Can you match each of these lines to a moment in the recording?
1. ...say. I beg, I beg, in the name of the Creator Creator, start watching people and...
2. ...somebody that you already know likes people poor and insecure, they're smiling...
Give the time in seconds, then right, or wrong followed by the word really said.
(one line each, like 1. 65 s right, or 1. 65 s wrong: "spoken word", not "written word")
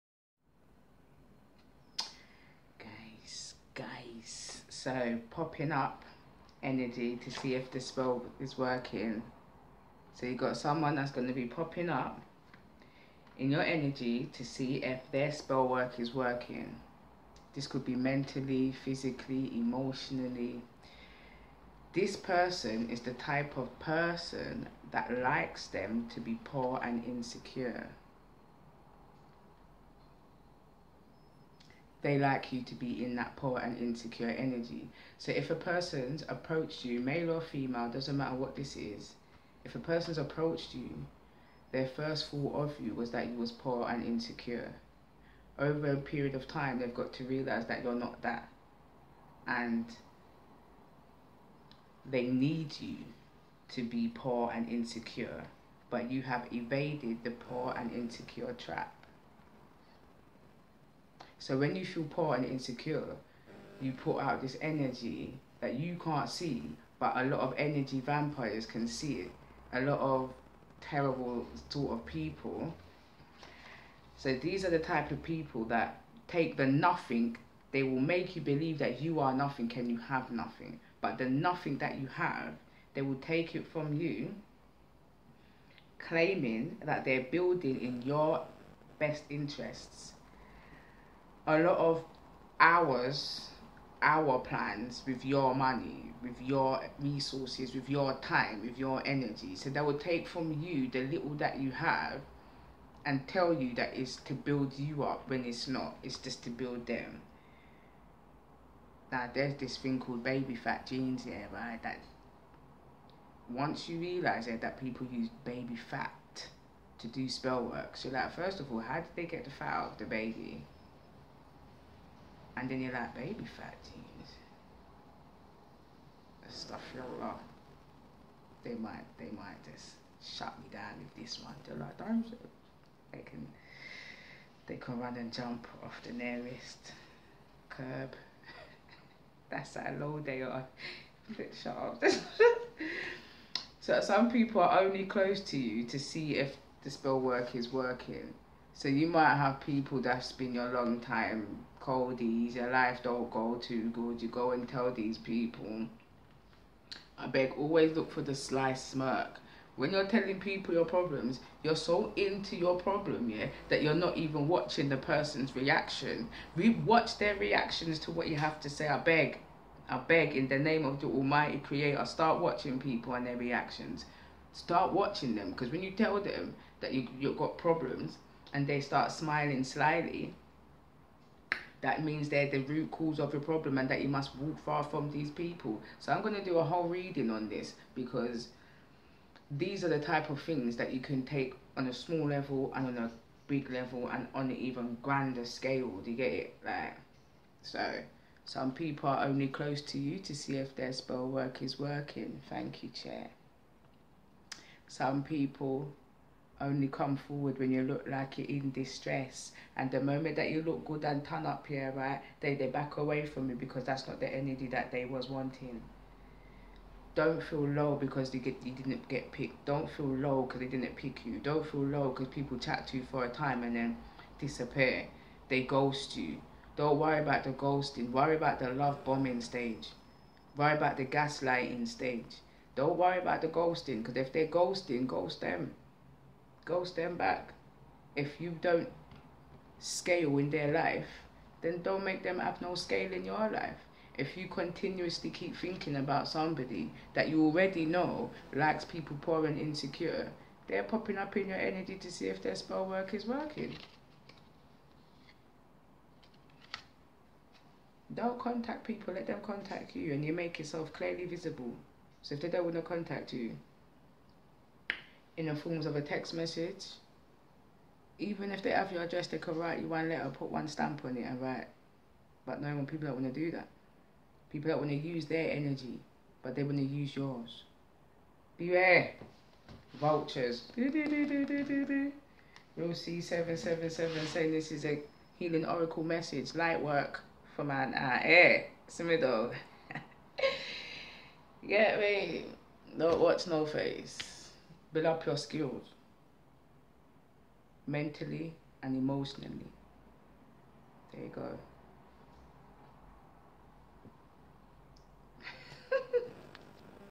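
1. 168 s wrong: "Almighty", not "Creator"
2. 246 s wrong: "popping", not "smiling".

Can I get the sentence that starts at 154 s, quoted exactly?
You go and tell these people.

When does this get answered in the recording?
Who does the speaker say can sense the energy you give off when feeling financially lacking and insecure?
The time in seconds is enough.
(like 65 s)
67 s.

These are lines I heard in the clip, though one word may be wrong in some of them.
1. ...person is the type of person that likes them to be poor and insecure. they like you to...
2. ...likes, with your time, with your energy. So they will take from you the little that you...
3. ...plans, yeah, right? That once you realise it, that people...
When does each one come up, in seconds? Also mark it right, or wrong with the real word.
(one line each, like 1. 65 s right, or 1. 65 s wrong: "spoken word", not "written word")
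1. 22 s right
2. 96 s wrong: "resources", not "likes"
3. 110 s wrong: "jeans", not "plans".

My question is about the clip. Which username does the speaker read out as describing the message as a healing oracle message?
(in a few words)
RealC777.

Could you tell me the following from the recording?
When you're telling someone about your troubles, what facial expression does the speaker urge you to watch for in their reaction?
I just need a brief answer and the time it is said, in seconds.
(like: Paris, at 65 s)
The sly smirk, at 158 s.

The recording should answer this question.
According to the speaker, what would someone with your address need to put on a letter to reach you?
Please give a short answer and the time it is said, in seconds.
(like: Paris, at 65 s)
One stamp, at 270 s.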